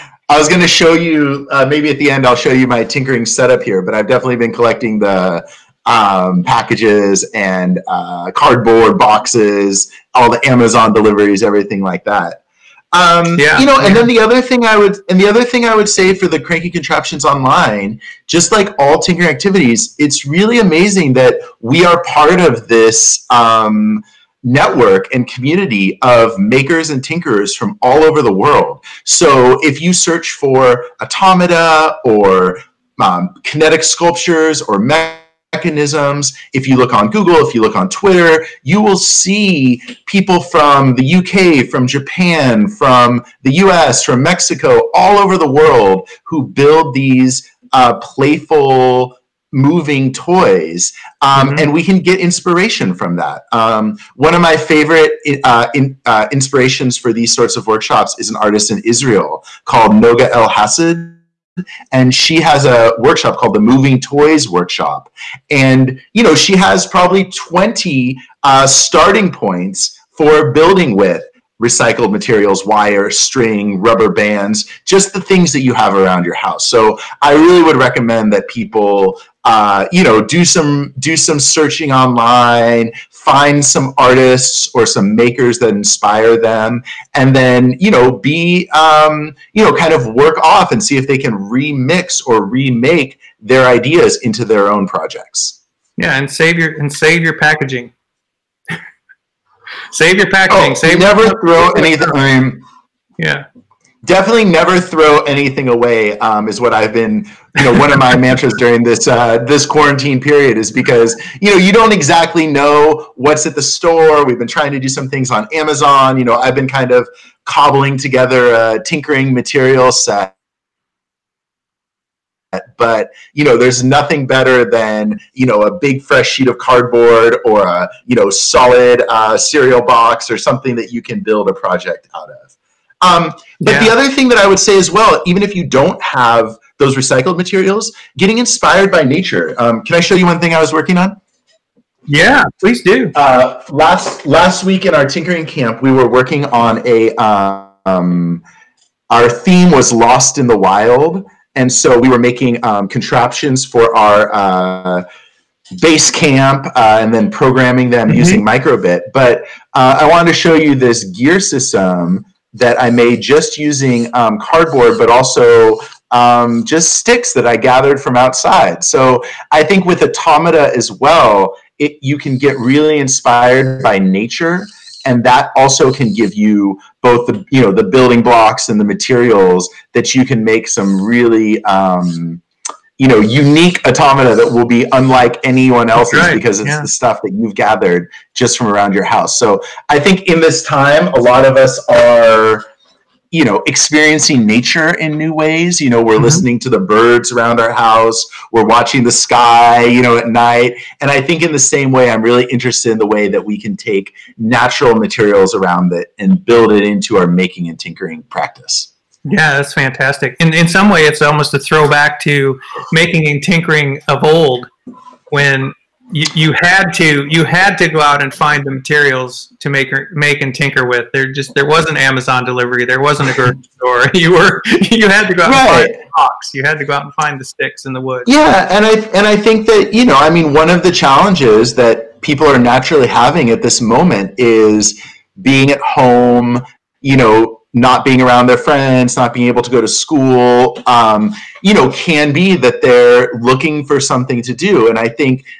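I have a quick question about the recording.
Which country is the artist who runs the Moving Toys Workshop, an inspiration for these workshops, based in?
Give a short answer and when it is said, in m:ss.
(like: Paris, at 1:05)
Israel, at 0:58.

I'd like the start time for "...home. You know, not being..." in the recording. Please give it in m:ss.
3:55.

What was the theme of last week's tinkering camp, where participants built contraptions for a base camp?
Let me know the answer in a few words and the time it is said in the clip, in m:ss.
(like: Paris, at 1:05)
Lost in the wild, at 2:29.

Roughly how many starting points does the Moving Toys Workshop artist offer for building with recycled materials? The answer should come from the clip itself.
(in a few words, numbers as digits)
20.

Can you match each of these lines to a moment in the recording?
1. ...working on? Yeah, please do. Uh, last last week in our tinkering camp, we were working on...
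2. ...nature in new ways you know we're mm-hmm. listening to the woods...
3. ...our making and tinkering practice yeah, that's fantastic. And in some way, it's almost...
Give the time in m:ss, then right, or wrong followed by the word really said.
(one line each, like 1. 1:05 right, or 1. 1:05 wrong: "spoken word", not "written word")
1. 2:20 right
2. 3:14 wrong: "birds", not "woods"
3. 3:27 right.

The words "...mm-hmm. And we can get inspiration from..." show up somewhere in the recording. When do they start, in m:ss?
0:51.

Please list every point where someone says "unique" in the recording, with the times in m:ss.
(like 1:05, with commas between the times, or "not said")
3:03.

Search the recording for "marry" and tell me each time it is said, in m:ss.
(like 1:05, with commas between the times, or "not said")
not said.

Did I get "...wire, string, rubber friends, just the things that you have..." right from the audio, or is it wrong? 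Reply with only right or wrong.
wrong.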